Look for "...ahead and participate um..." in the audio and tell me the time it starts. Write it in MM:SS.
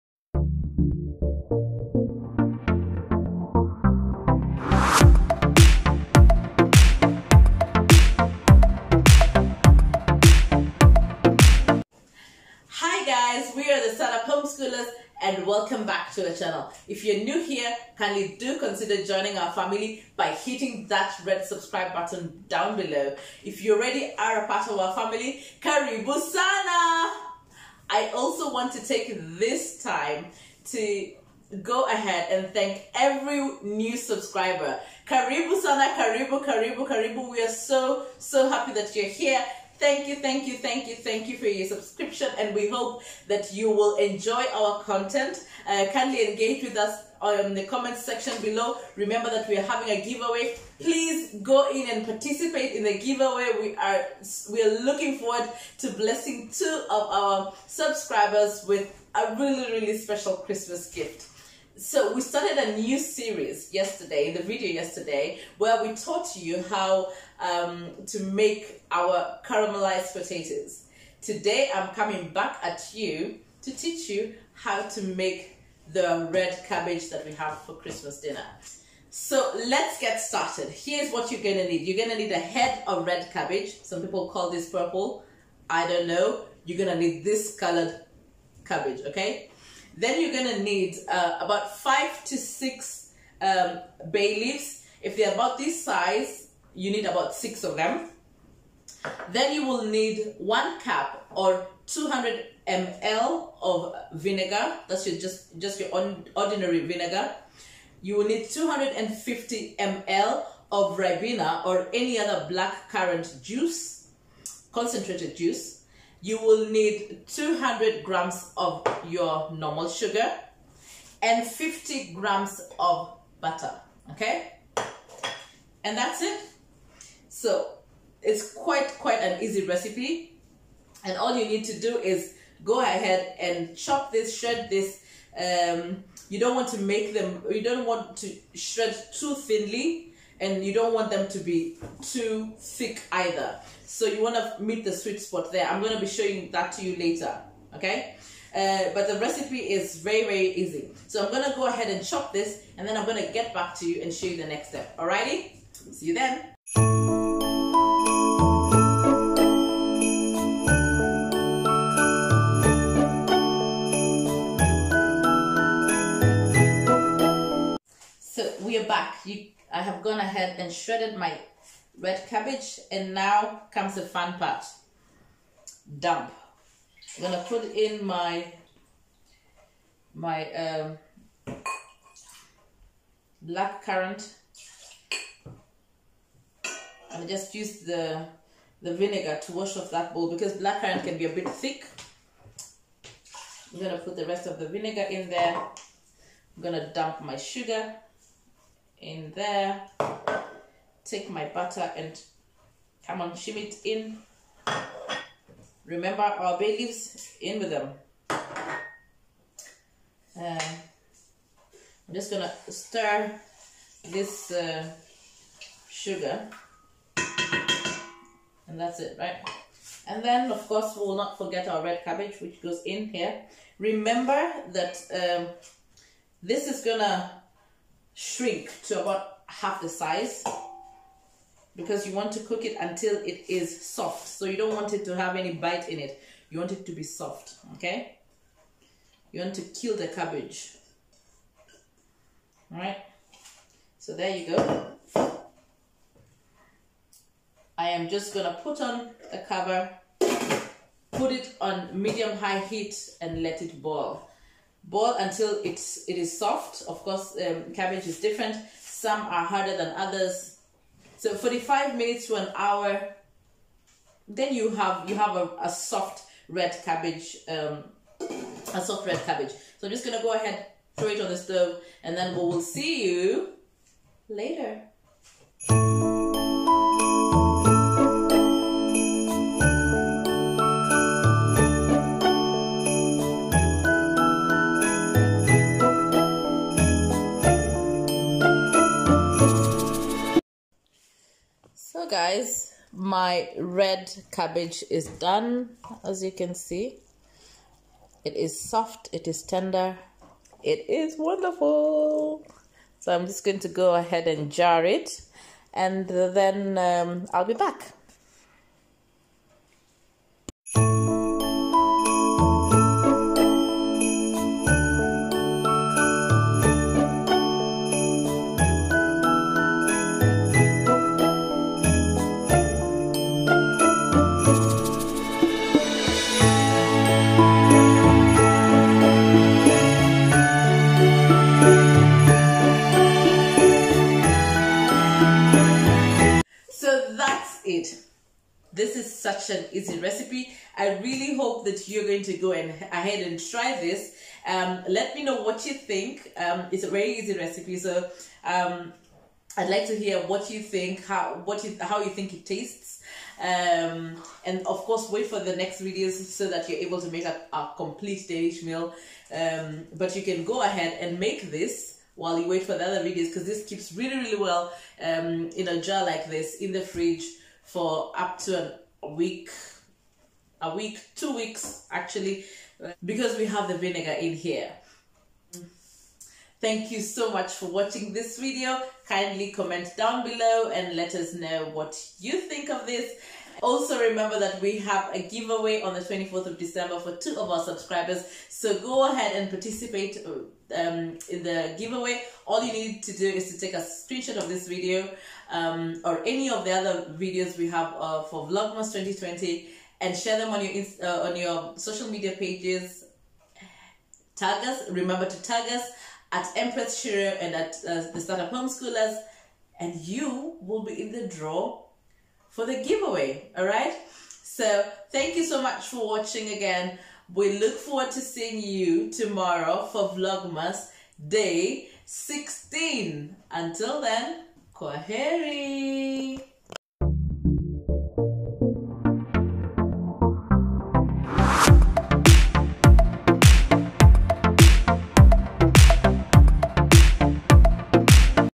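06:29.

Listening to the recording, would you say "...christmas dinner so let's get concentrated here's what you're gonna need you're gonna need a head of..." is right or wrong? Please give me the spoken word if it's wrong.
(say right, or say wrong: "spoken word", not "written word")
wrong: "started", not "concentrated".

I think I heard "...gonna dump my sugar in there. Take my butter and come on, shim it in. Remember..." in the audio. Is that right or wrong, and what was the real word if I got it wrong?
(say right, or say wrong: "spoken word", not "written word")
right.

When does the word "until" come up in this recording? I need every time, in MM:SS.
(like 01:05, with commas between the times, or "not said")
03:52, 04:15, 07:03.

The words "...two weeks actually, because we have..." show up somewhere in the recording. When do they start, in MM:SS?
06:11.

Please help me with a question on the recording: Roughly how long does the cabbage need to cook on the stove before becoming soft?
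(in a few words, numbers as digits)
45 minutes to an hour.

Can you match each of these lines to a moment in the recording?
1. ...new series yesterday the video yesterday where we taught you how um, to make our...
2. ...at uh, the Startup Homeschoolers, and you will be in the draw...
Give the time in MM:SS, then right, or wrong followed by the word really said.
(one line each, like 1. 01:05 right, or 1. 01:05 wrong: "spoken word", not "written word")
1. 01:02 right
2. 06:47 right.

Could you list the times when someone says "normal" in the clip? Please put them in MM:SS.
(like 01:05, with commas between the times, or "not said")
01:59.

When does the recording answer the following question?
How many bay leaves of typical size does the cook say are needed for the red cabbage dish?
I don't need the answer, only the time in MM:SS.
01:36.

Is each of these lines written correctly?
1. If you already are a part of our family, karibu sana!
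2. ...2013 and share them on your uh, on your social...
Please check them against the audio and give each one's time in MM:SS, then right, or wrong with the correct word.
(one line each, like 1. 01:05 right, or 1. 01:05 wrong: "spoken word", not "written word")
1. 00:23 right
2. 06:38 wrong: "2020", not "2013".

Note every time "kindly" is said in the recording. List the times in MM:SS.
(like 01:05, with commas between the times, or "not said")
00:17, 00:45, 06:19.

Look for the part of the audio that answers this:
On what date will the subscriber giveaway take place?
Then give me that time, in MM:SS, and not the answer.
06:25.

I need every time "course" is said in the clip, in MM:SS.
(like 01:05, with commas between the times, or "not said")
03:40, 04:17, 05:54.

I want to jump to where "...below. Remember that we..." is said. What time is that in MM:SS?
00:48.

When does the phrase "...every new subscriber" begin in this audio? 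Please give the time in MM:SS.
00:32.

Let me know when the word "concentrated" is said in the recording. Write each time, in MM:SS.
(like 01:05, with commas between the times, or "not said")
01:54.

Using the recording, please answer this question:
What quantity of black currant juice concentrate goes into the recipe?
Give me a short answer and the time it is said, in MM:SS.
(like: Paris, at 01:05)
250 ml, at 01:48.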